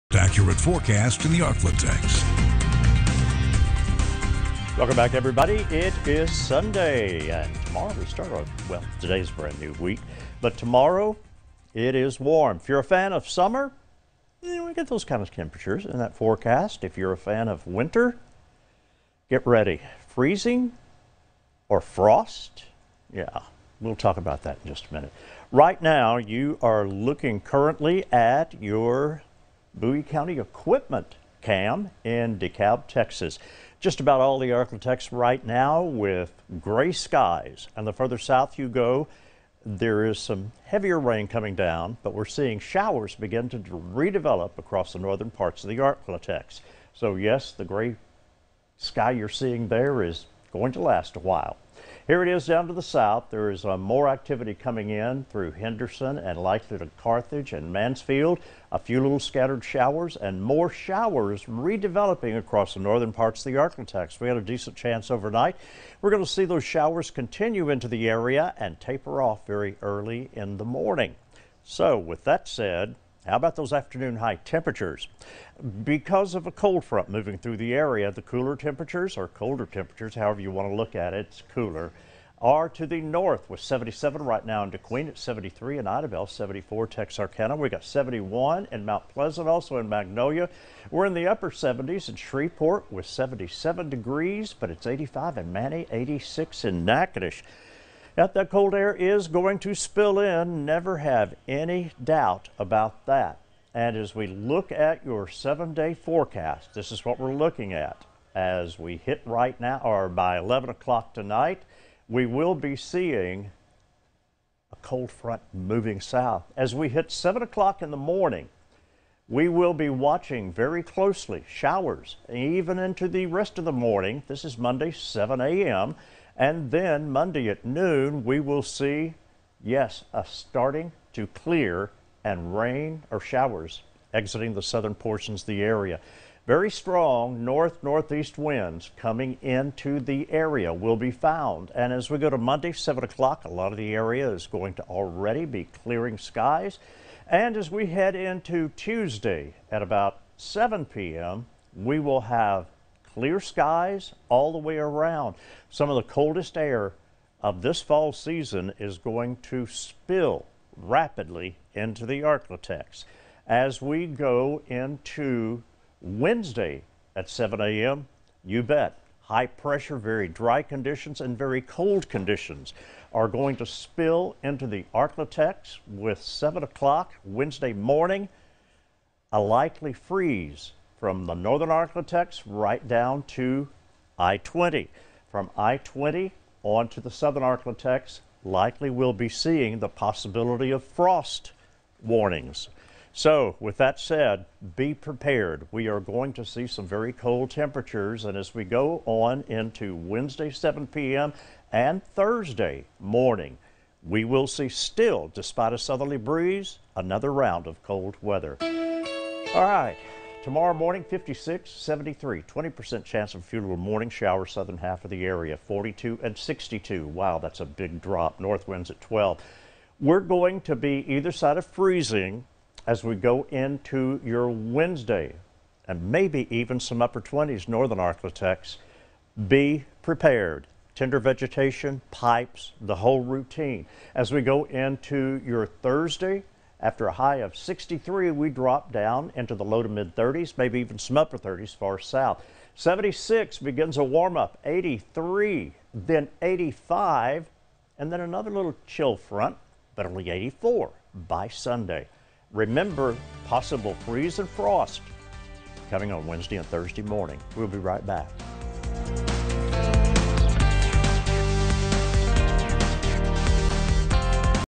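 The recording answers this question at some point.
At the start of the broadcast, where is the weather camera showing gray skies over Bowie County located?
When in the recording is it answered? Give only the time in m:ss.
0:32.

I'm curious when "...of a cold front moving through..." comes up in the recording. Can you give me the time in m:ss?
1:16.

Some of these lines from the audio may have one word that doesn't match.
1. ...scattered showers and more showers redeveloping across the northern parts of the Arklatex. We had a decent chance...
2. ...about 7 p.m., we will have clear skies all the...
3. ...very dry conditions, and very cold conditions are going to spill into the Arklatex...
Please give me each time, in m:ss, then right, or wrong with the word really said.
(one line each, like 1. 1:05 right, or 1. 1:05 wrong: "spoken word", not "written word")
1. 0:59 right
2. 2:29 right
3. 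2:49 right.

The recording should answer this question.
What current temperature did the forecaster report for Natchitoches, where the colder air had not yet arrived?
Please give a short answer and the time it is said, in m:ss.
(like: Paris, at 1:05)
86, at 1:35.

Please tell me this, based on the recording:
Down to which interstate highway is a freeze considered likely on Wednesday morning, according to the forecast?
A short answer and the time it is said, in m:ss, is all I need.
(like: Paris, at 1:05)
I-20, at 3:02.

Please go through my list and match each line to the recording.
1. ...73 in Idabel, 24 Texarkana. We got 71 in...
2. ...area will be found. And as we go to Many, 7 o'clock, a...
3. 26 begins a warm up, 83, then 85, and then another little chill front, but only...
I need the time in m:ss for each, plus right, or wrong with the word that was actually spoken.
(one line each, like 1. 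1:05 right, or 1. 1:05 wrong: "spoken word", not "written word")
1. 1:25 wrong: "74", not "24"
2. 2:20 wrong: "Monday", not "Many"
3. 4:02 wrong: "76", not "26".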